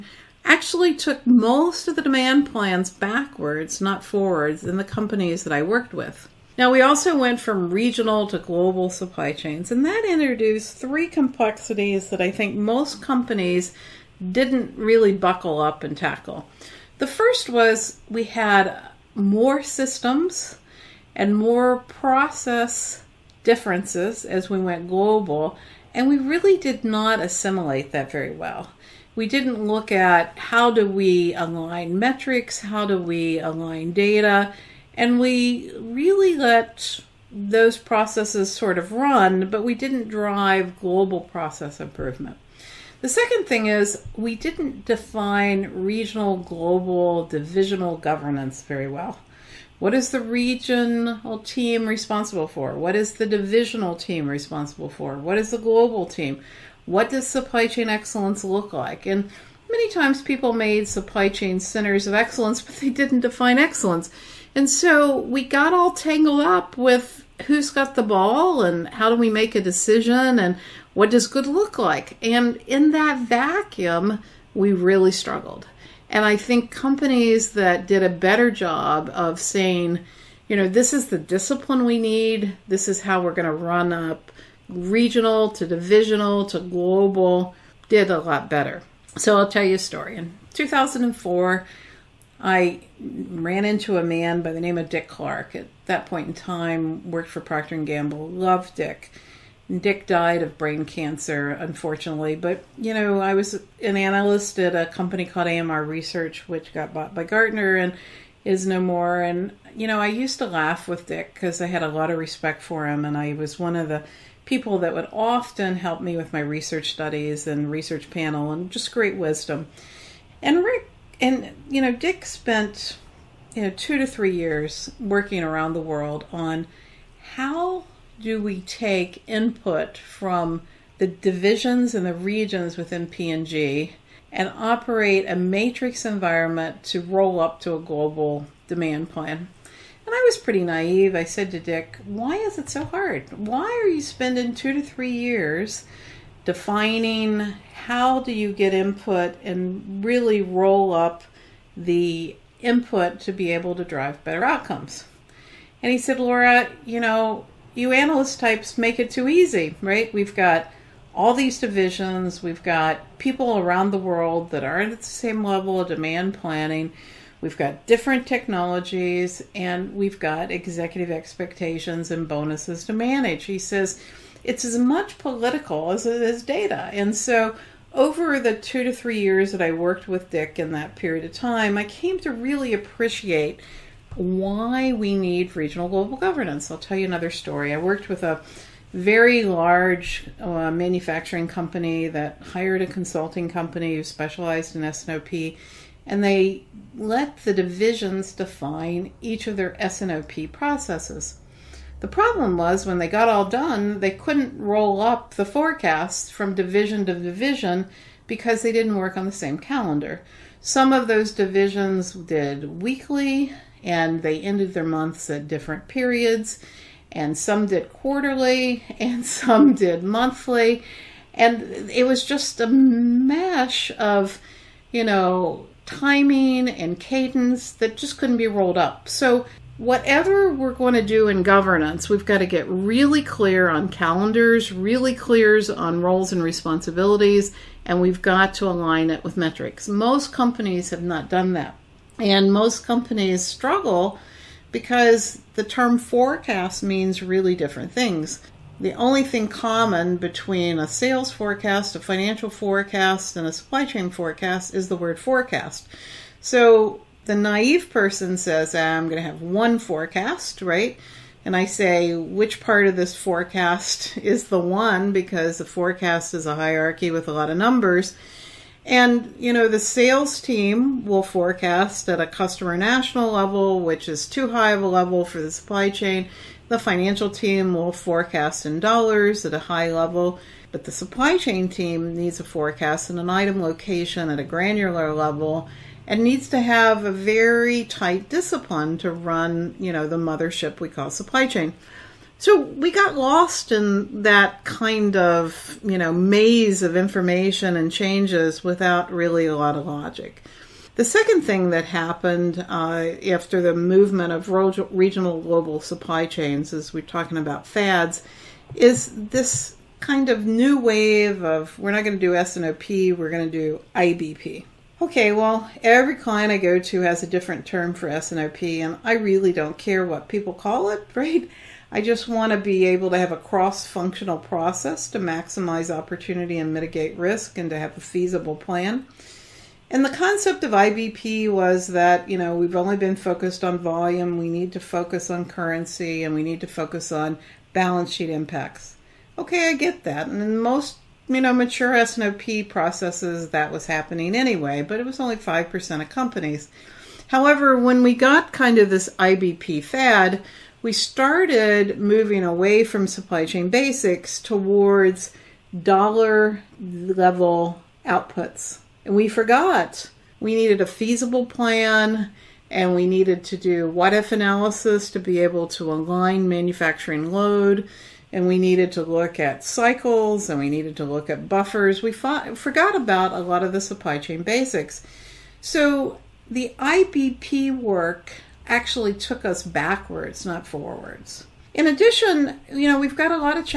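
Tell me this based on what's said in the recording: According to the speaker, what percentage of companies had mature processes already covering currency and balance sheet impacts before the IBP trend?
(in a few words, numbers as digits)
5%.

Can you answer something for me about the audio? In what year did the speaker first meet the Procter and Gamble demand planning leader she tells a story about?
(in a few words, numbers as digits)
2004.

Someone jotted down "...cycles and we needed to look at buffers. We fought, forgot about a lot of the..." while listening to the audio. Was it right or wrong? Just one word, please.
right.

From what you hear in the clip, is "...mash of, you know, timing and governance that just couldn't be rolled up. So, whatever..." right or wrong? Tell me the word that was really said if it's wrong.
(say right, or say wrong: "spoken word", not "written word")
wrong: "cadence", not "governance".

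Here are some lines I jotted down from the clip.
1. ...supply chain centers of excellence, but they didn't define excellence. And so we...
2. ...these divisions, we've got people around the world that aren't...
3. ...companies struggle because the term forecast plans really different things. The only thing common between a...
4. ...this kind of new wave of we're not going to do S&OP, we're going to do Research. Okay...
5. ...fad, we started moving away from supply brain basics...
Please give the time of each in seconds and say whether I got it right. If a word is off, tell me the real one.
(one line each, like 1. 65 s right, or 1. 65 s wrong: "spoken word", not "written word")
1. 60 s right
2. 161 s right
3. 242 s wrong: "means", not "plans"
4. 309 s wrong: "IBP", not "Research"
5. 349 s wrong: "chain", not "brain".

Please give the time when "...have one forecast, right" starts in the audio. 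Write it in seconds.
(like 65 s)
259 s.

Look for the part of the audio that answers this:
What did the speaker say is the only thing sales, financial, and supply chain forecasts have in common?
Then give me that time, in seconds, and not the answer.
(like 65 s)
254 s.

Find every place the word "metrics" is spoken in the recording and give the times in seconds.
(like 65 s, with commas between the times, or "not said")
31 s, 239 s.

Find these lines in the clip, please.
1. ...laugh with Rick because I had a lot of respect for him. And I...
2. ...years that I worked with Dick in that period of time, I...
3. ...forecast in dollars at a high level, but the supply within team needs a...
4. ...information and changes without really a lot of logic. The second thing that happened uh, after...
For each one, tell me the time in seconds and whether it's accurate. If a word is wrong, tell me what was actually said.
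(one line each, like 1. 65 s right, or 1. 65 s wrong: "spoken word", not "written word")
1. 110 s wrong: "Dick", not "Rick"
2. 179 s right
3. 277 s wrong: "chain", not "within"
4. 296 s right.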